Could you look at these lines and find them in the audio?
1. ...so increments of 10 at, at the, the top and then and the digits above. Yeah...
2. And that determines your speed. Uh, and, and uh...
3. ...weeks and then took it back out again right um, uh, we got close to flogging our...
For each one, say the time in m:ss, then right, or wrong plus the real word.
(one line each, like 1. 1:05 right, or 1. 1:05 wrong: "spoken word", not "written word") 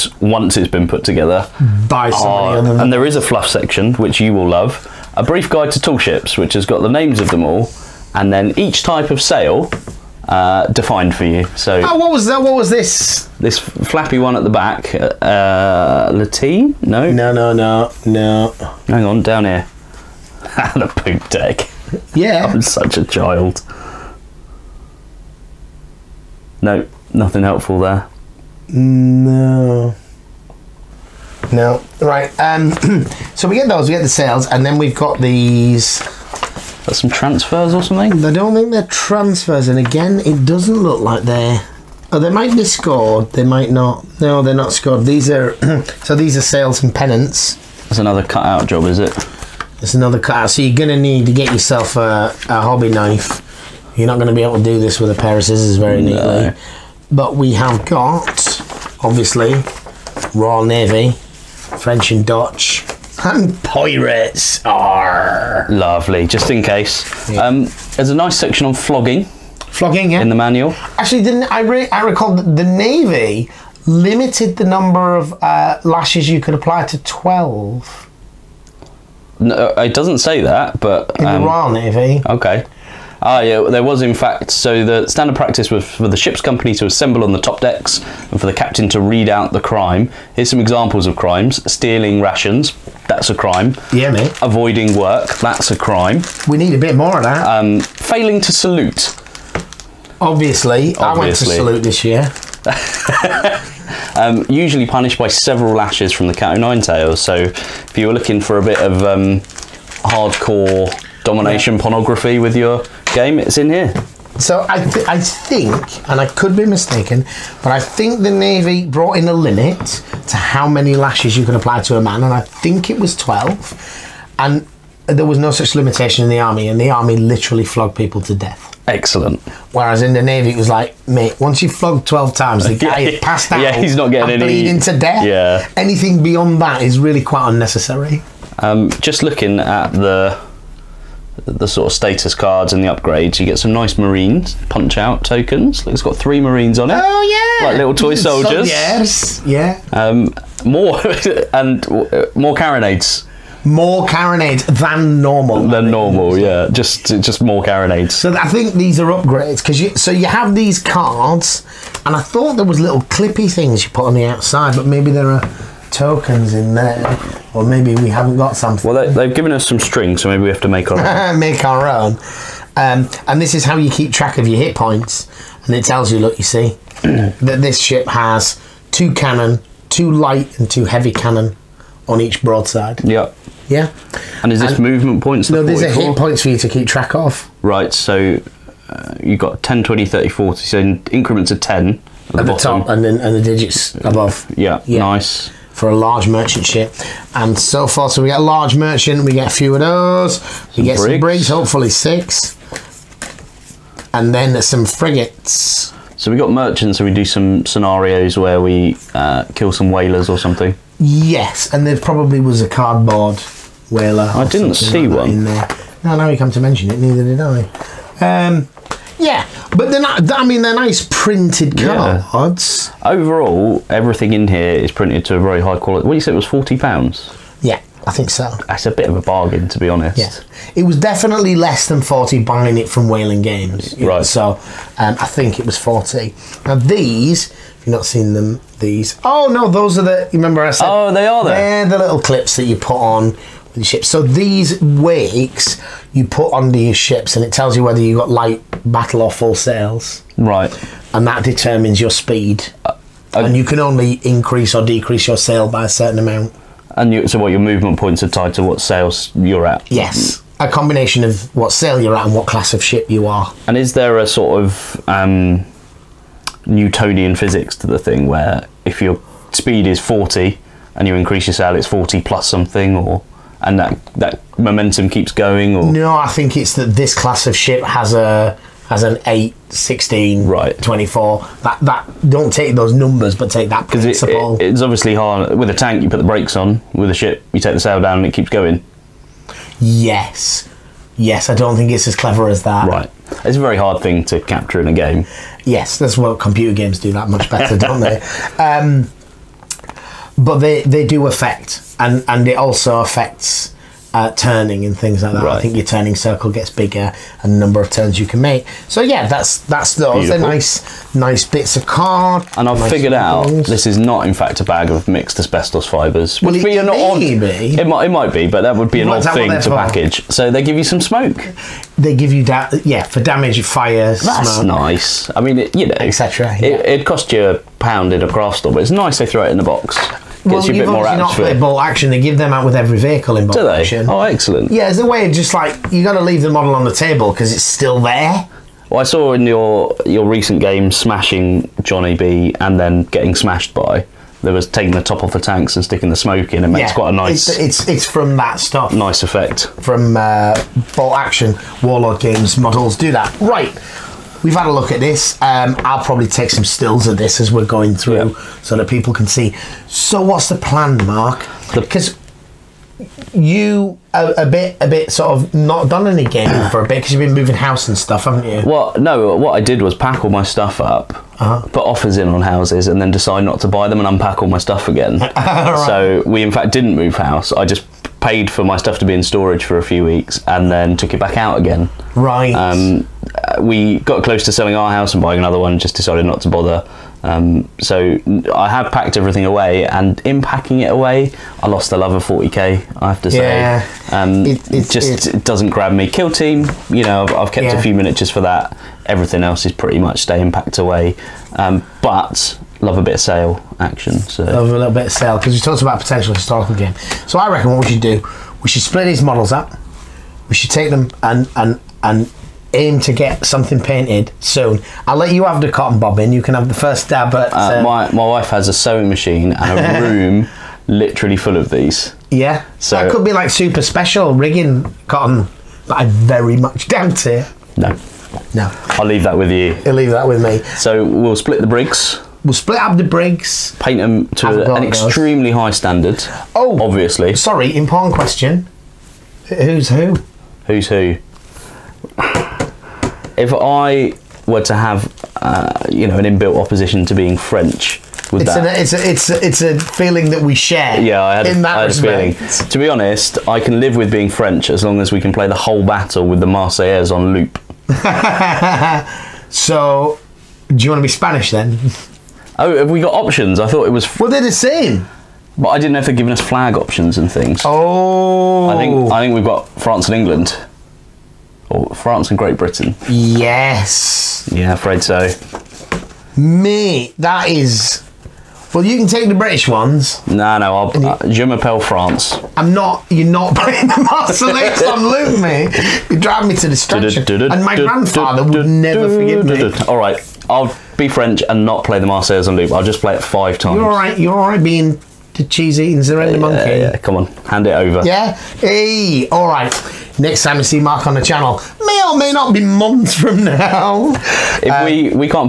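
1. 3:10 right
2. 4:11 right
3. 6:20 wrong: "selling", not "flogging".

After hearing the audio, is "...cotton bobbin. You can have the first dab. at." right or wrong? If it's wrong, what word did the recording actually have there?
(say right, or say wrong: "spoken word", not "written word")
right.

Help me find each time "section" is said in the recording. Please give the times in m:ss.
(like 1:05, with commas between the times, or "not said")
0:03, 1:08.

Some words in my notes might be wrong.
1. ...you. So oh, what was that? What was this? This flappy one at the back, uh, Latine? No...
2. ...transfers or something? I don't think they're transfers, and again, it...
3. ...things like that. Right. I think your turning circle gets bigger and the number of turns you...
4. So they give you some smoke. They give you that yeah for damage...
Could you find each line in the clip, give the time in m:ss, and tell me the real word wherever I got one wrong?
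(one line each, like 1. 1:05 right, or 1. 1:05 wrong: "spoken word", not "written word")
1. 0:11 right
2. 0:37 right
3. 5:04 right
4. 5:20 right.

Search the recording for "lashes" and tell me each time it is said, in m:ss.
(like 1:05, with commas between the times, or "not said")
1:15, 1:45, 2:00.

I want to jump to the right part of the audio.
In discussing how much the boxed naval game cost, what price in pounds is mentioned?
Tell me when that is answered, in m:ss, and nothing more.
3:46.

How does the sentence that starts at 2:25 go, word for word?
it's got three Marines on it.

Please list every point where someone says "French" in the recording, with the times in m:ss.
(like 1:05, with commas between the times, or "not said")
1:01, 7:27, 7:34, 8:11.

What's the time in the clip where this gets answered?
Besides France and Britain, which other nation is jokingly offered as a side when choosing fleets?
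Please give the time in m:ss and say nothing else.
7:41.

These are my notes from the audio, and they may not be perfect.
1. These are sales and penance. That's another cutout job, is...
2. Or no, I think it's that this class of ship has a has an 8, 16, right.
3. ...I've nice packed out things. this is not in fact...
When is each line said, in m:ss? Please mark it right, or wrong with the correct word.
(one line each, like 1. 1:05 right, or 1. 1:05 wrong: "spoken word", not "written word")
1. 0:46 right
2. 4:35 right
3. 5:12 wrong: "figured", not "packed".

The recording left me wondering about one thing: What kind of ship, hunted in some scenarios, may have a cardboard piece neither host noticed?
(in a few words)
Whaler.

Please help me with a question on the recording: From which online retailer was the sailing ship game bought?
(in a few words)
Wayland Games.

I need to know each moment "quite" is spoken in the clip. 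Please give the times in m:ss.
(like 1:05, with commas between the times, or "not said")
2:17, 5:46.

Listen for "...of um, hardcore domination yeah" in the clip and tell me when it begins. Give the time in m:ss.
1:48.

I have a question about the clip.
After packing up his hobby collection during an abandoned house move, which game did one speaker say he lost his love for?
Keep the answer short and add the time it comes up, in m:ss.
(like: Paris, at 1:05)
40k, at 6:32.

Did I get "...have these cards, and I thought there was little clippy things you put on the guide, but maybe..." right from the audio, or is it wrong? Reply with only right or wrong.
wrong.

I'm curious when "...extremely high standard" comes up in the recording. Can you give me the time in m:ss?
7:14.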